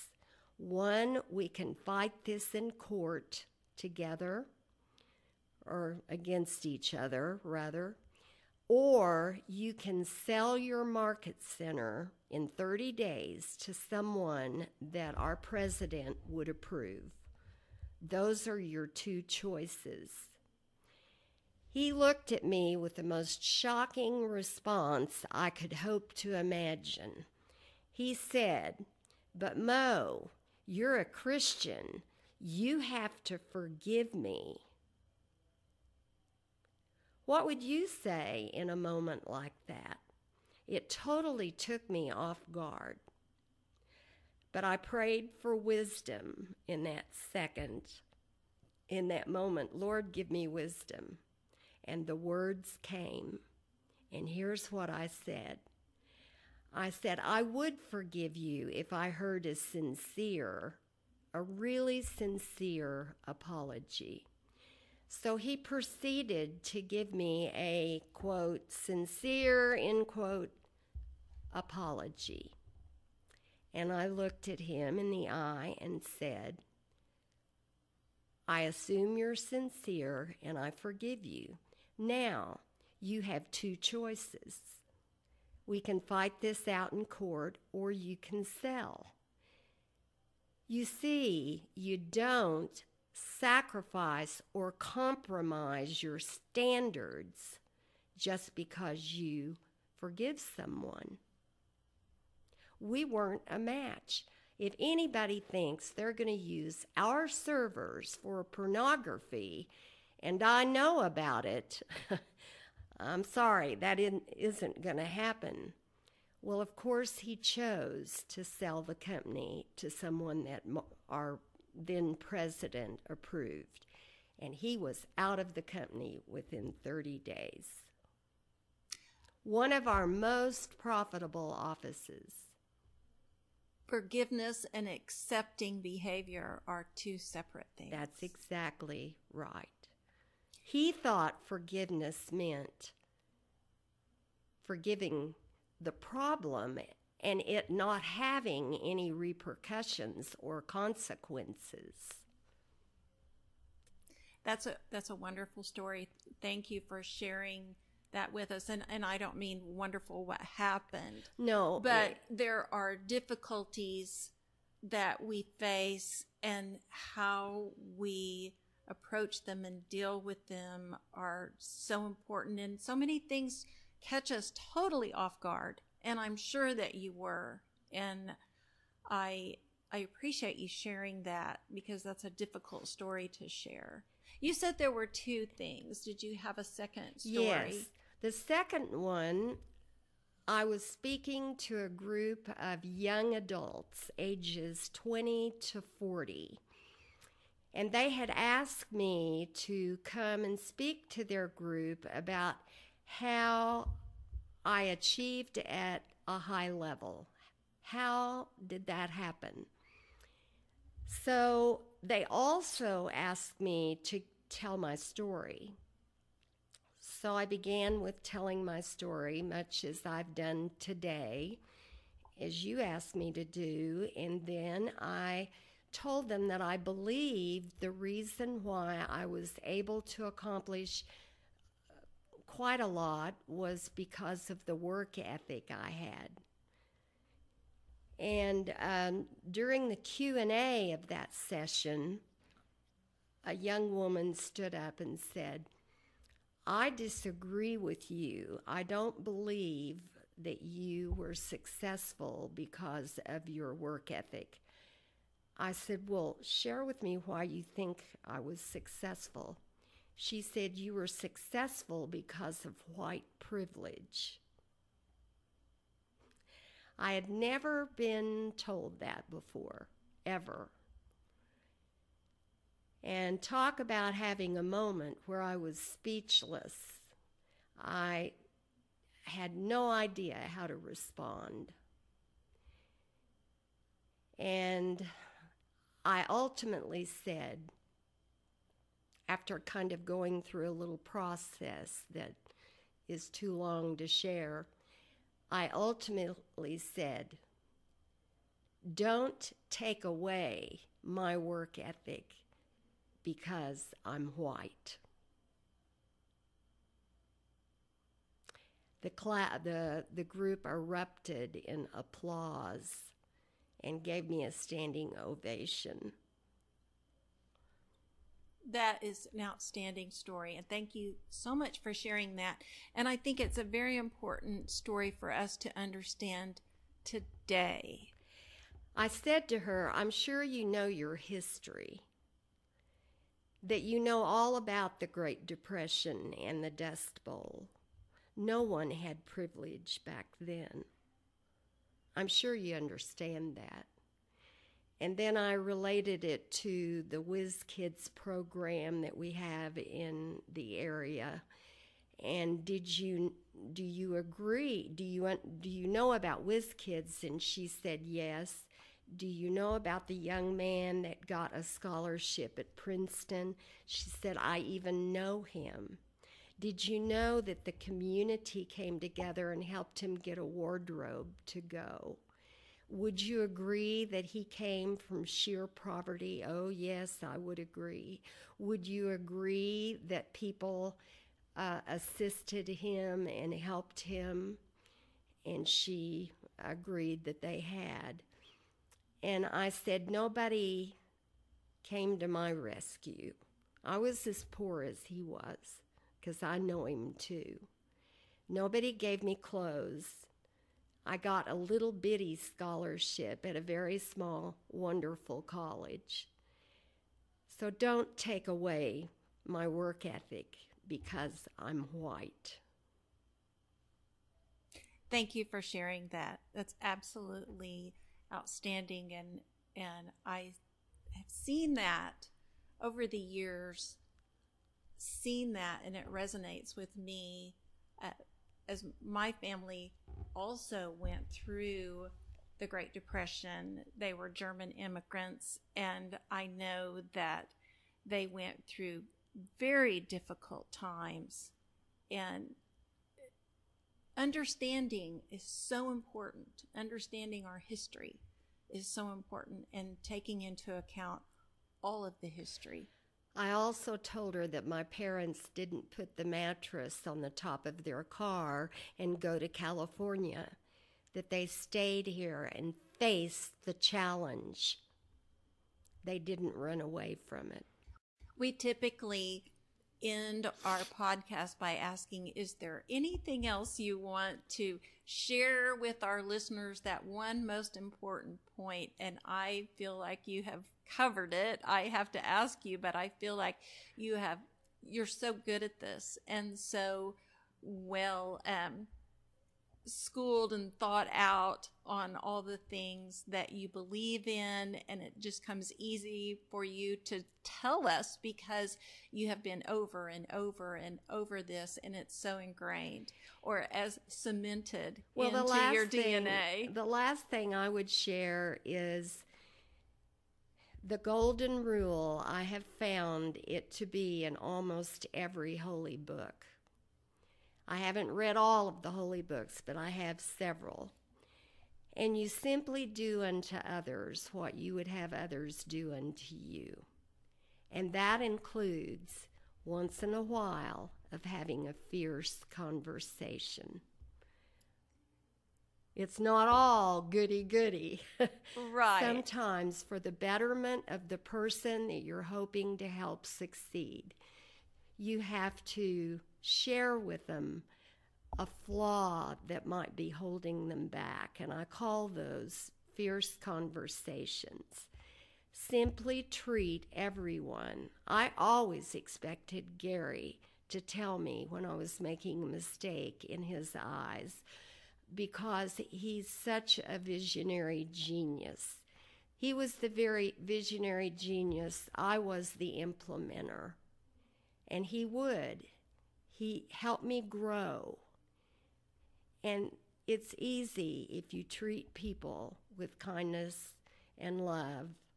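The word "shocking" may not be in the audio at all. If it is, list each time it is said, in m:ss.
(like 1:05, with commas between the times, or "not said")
0:23.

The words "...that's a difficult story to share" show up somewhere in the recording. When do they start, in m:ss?
3:02.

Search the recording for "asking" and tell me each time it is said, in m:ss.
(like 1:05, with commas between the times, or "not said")
7:51.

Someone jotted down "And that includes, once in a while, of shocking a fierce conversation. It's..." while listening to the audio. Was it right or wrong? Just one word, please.
wrong.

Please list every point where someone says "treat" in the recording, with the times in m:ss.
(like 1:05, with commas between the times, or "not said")
9:16, 9:41.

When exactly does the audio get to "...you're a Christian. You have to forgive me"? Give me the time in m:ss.
0:30.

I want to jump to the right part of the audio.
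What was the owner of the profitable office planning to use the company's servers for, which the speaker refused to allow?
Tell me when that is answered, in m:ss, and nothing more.
1:48.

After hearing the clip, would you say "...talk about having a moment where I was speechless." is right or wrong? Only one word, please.
right.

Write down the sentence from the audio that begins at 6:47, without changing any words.
So don't take away my work ethic because I'm white.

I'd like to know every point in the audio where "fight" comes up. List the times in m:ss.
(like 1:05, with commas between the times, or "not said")
0:01, 1:25.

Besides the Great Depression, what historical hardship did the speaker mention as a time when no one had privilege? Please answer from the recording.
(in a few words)
The Dust Bowl.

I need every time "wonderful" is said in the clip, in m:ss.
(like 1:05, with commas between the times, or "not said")
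2:35, 2:39, 6:44.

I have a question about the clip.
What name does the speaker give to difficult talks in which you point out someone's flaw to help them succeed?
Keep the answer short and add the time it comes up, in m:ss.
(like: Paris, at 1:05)
Fierce conversations, at 9:12.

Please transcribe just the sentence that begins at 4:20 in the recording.
She said, You were successful because of white privilege.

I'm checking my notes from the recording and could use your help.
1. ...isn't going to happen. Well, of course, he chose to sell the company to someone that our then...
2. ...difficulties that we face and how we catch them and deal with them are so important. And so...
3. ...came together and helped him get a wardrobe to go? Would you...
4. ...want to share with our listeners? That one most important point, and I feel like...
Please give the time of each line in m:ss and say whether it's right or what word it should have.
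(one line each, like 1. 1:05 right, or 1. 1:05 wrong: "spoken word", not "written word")
1. 1:53 right
2. 2:42 wrong: "approach", not "catch"
3. 6:08 right
4. 7:53 right.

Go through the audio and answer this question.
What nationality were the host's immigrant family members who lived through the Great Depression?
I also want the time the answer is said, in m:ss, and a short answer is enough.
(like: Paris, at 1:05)
German, at 7:14.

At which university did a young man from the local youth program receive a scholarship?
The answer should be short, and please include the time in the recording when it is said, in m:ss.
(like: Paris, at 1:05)
Princeton, at 6:02.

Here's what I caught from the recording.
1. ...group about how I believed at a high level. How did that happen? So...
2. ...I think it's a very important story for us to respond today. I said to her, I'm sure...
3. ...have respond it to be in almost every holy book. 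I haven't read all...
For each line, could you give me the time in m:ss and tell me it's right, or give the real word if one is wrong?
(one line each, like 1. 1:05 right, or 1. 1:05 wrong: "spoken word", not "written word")
1. 3:21 wrong: "achieved", not "believed"
2. 5:23 wrong: "understand", not "respond"
3. 8:32 wrong: "found", not "respond".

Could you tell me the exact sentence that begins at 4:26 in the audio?
I had never been told that before, ever.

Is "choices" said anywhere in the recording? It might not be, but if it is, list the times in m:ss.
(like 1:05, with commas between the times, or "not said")
0:19, 1:23.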